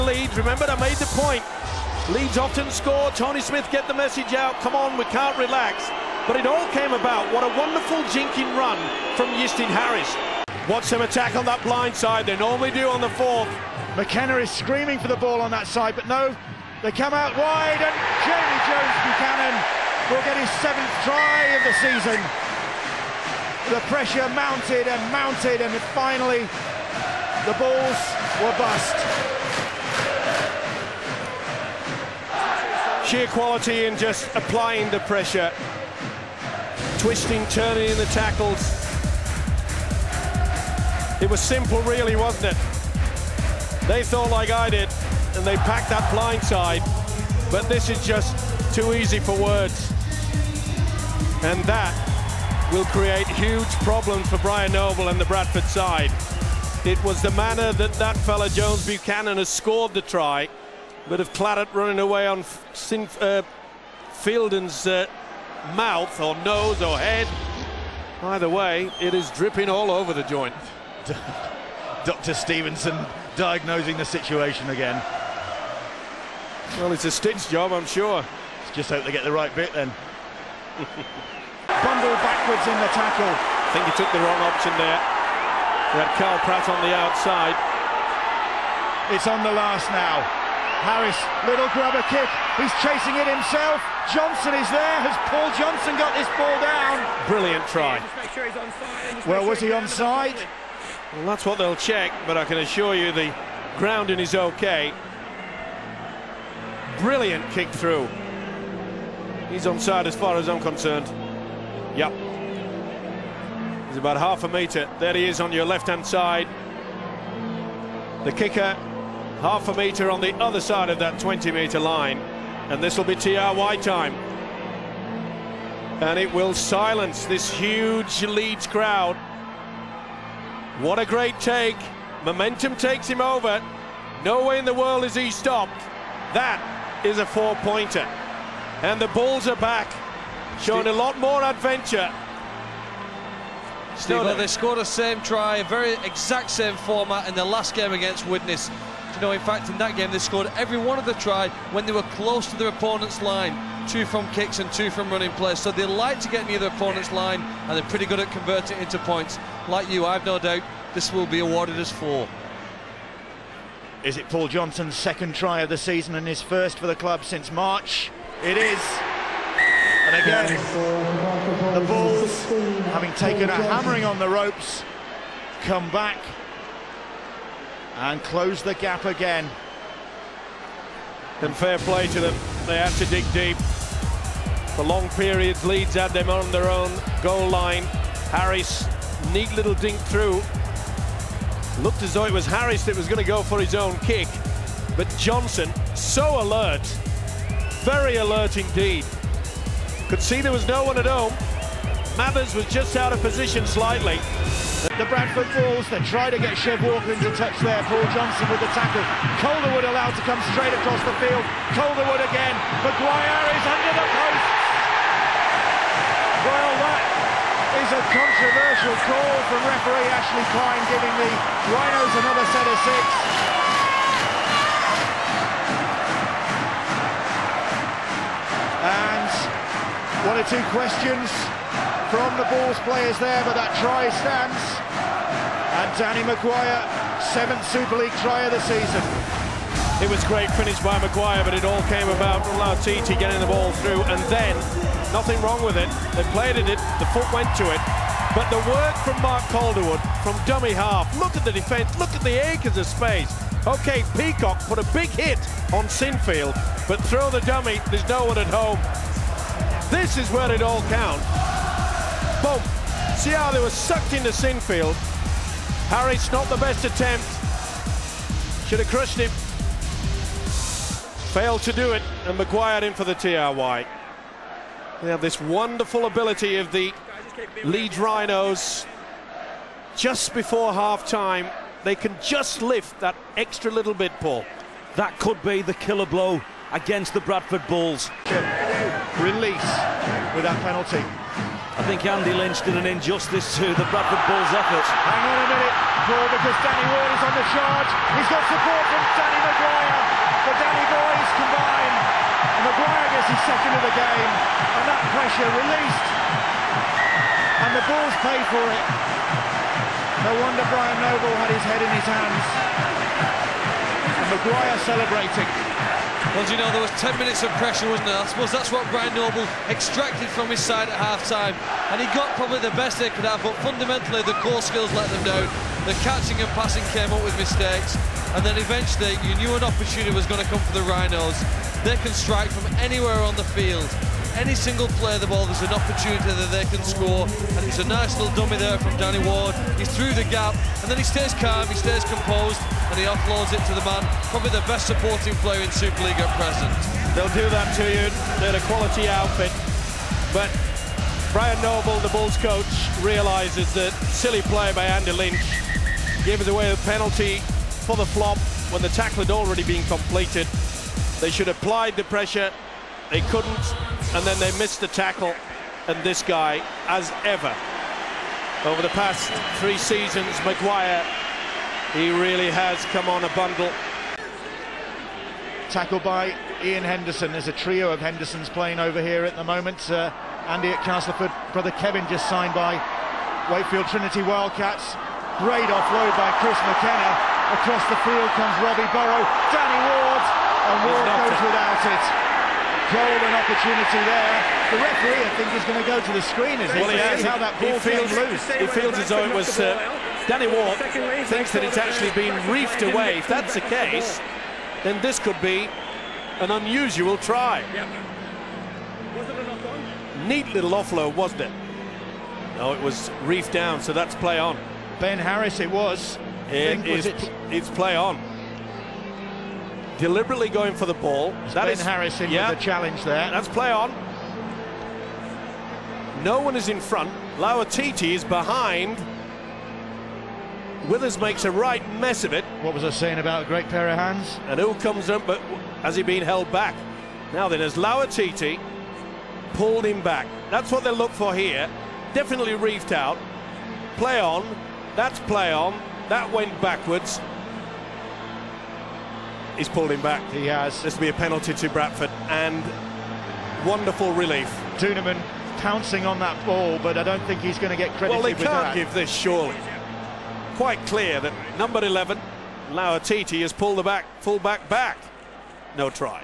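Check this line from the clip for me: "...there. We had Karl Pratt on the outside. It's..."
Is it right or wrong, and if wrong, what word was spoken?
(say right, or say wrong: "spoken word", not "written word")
right.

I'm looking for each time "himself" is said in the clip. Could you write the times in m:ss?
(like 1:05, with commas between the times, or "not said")
1:33.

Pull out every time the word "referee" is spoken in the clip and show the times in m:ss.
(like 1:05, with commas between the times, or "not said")
3:39, 6:34.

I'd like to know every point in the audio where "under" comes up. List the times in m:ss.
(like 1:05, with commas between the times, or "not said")
3:33.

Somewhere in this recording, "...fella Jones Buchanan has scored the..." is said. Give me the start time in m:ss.
0:58.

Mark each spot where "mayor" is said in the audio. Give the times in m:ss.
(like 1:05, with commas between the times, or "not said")
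not said.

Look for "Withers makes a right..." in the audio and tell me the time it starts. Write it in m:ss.
7:10.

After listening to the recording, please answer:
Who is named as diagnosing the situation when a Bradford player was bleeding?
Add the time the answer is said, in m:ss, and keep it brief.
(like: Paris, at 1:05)
Dr. Stevenson, at 1:12.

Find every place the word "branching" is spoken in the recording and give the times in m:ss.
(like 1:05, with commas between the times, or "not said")
not said.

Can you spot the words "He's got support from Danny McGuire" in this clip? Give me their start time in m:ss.
4:58.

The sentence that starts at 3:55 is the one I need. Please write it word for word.
And Danny McGuire, seventh Super League try of the season.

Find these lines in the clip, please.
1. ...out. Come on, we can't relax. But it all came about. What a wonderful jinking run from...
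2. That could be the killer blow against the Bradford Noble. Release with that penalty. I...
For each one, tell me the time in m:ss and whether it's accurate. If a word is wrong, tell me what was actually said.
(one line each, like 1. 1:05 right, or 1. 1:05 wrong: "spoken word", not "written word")
1. 0:04 right
2. 4:44 wrong: "Bulls", not "Noble".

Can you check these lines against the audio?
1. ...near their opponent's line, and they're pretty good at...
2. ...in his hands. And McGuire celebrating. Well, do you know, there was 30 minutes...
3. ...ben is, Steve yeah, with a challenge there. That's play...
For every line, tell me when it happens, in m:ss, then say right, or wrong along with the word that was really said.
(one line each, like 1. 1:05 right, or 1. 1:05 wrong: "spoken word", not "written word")
1. 2:36 right
2. 5:11 wrong: "10", not "30"
3. 7:01 wrong: "Harris", not "Steve".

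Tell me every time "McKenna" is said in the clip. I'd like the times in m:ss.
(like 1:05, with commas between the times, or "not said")
0:13, 6:26.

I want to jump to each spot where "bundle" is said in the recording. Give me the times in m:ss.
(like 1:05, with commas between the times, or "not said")
1:21, 6:13.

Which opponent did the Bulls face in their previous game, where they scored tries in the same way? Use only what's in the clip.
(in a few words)
Widnes.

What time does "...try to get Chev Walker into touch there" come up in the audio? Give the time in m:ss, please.
3:26.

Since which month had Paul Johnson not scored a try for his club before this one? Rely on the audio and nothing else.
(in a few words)
March.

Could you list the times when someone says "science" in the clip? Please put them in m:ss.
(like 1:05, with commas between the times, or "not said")
not said.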